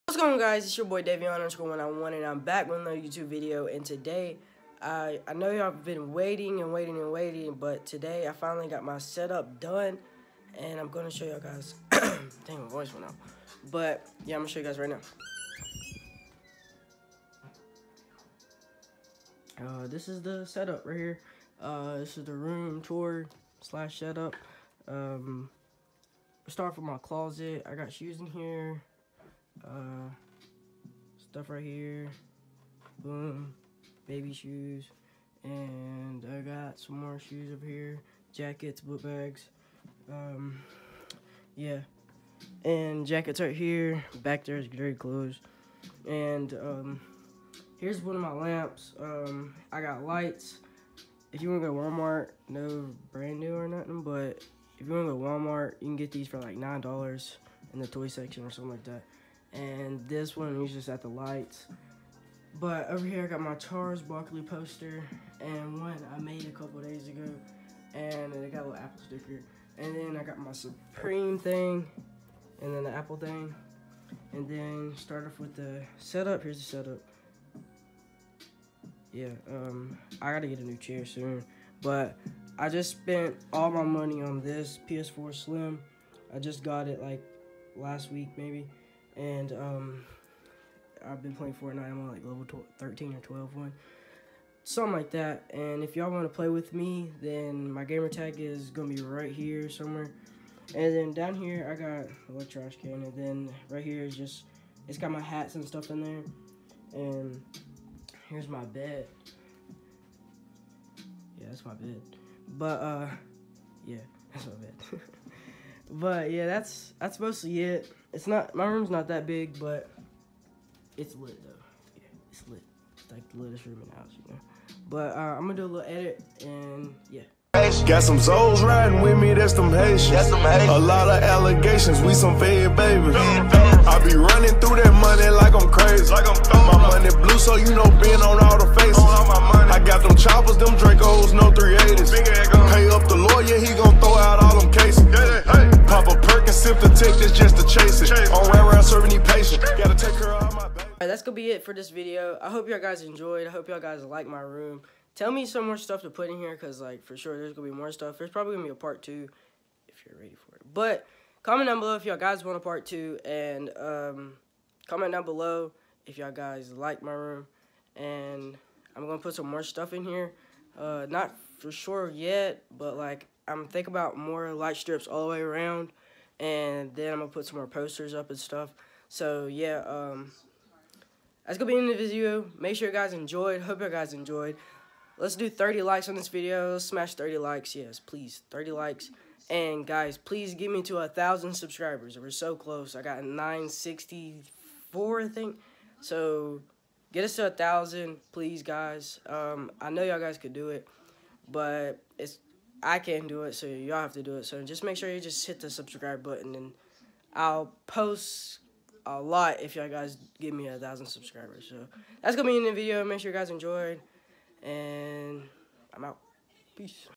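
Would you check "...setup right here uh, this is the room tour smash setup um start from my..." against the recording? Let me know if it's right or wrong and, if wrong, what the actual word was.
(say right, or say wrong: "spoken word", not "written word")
wrong: "slash", not "smash".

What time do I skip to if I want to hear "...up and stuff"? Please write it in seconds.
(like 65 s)
178 s.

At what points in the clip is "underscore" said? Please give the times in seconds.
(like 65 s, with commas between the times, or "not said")
1 s.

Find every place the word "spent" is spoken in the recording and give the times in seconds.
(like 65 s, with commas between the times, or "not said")
82 s.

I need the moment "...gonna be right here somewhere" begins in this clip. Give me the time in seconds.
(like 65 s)
98 s.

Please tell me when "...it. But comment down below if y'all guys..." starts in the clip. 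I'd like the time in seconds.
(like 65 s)
160 s.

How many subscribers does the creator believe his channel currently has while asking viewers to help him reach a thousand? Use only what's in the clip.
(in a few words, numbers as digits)
964.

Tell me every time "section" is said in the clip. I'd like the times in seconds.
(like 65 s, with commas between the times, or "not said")
58 s.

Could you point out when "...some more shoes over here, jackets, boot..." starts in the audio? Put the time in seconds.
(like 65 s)
36 s.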